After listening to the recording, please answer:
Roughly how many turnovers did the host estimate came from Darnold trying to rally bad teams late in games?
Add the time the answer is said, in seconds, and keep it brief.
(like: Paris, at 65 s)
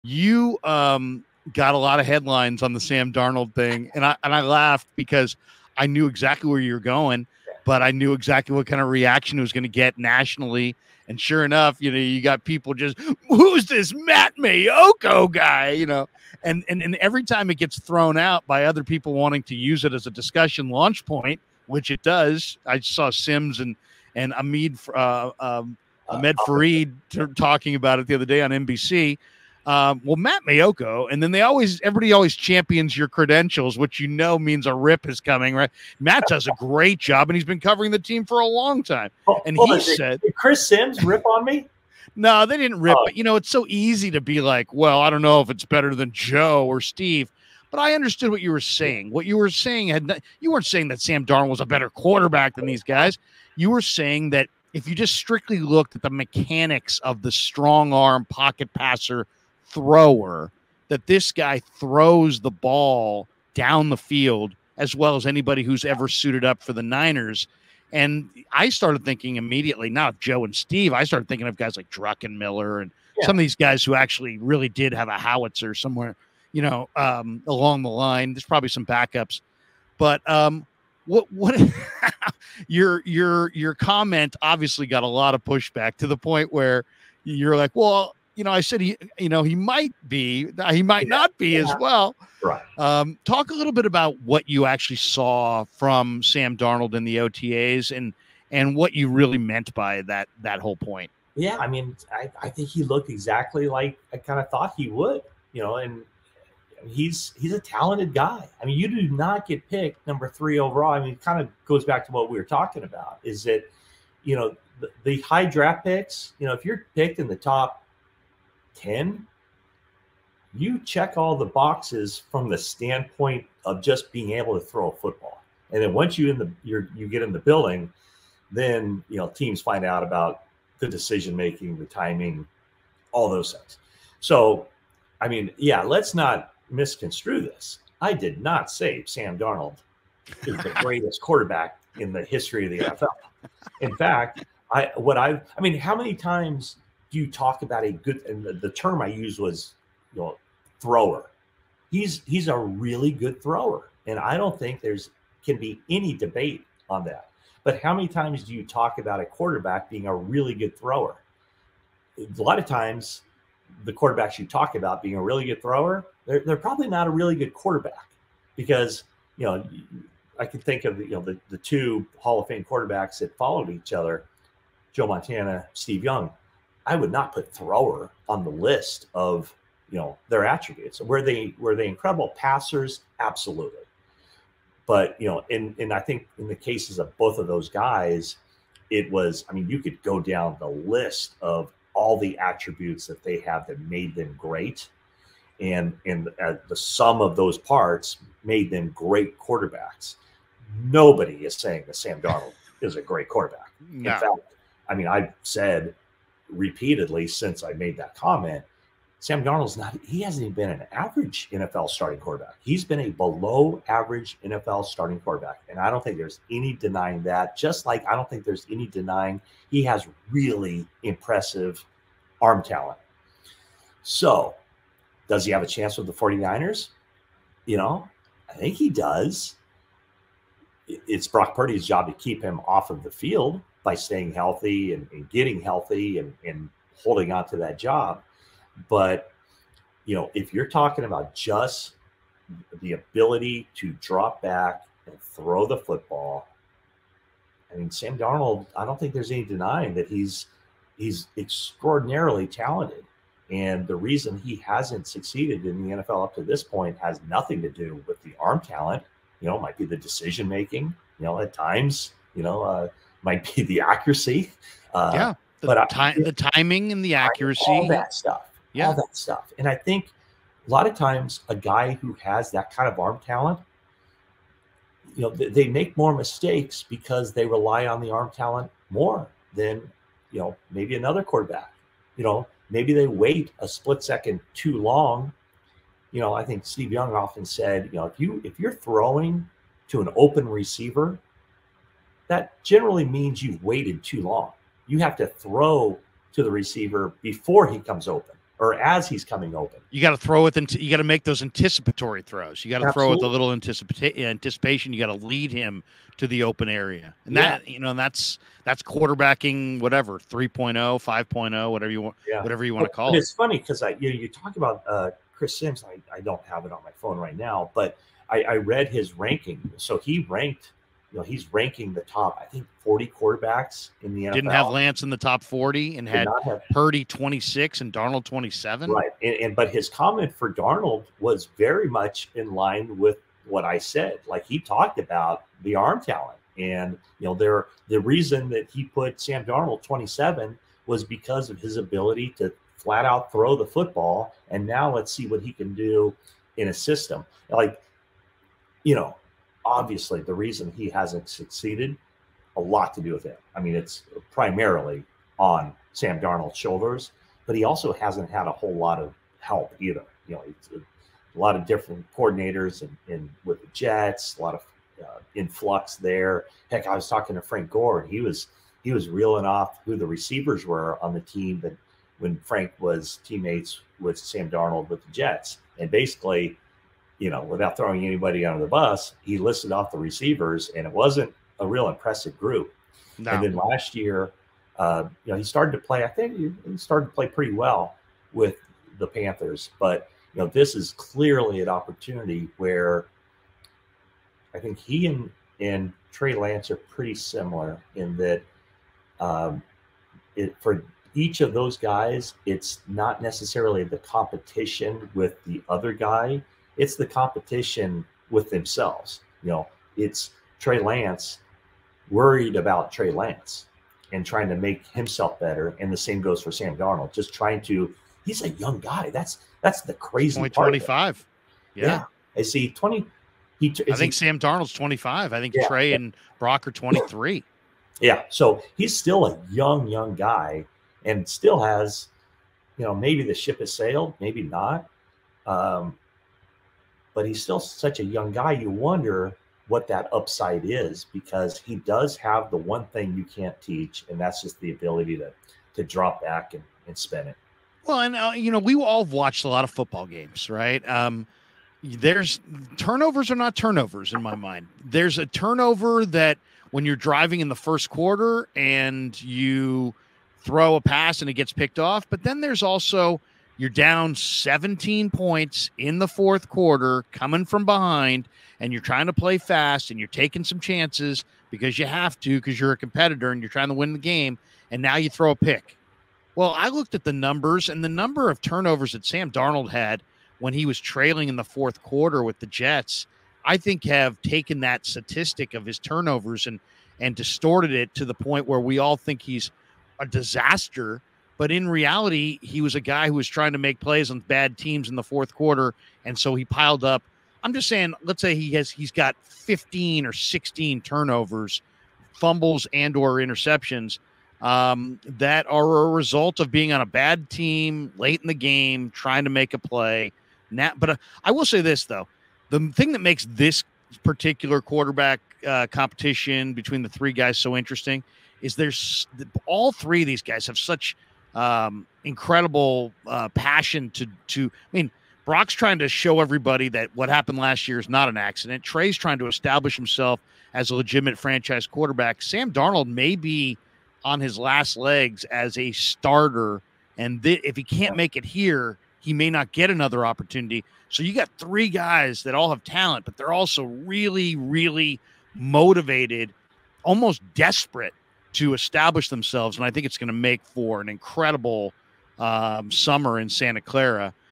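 15 or 16, at 499 s.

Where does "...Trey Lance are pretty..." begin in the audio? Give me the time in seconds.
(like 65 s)
396 s.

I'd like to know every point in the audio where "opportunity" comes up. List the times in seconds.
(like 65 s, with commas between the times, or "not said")
391 s, 540 s.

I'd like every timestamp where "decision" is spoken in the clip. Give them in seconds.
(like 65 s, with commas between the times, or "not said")
130 s, 259 s.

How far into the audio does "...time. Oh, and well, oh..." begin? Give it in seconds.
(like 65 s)
38 s.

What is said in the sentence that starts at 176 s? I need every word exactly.
I would not put thrower on the list of you know their attributes.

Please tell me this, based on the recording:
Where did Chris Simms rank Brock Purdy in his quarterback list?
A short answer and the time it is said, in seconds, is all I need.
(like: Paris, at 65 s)
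26, at 326 s.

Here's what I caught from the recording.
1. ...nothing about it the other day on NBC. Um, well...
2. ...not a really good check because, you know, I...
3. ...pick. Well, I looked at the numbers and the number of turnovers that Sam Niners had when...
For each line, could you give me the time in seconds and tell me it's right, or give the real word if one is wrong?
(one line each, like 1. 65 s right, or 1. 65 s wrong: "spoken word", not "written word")
1. 27 s wrong: "talking", not "nothing"
2. 166 s wrong: "quarterback", not "check"
3. 475 s wrong: "Darnold", not "Niners".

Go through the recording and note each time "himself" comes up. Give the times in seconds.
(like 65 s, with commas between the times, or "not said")
414 s, 529 s.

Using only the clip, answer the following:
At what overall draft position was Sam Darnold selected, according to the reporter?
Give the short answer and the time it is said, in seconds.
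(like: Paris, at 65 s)
3, at 110 s.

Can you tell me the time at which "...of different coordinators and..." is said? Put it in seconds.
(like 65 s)
361 s.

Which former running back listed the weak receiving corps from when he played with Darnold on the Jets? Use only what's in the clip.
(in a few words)
Frank Gore.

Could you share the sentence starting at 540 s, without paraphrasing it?
So you got three guys that all have talent, but they're also really, really motivated, almost desperate to establish themselves.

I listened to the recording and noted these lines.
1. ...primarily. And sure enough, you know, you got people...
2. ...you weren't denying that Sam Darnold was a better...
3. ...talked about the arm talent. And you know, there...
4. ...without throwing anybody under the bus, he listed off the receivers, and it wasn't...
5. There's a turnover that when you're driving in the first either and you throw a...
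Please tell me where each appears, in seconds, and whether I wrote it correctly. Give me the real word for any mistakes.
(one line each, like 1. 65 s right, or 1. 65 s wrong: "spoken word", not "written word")
1. 9 s wrong: "nationally", not "primarily"
2. 50 s wrong: "saying", not "denying"
3. 334 s right
4. 377 s right
5. 454 s wrong: "quarter", not "either".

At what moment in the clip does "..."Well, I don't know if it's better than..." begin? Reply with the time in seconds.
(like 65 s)
44 s.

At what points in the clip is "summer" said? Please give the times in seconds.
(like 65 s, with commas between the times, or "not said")
552 s.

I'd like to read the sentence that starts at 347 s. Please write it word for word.
Like, you know, obviously the reason he hasn't succeeded a lot to do with it.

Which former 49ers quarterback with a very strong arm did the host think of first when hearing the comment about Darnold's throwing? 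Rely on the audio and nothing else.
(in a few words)
Druckenmiller.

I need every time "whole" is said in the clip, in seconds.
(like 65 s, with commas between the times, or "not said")
100 s, 358 s.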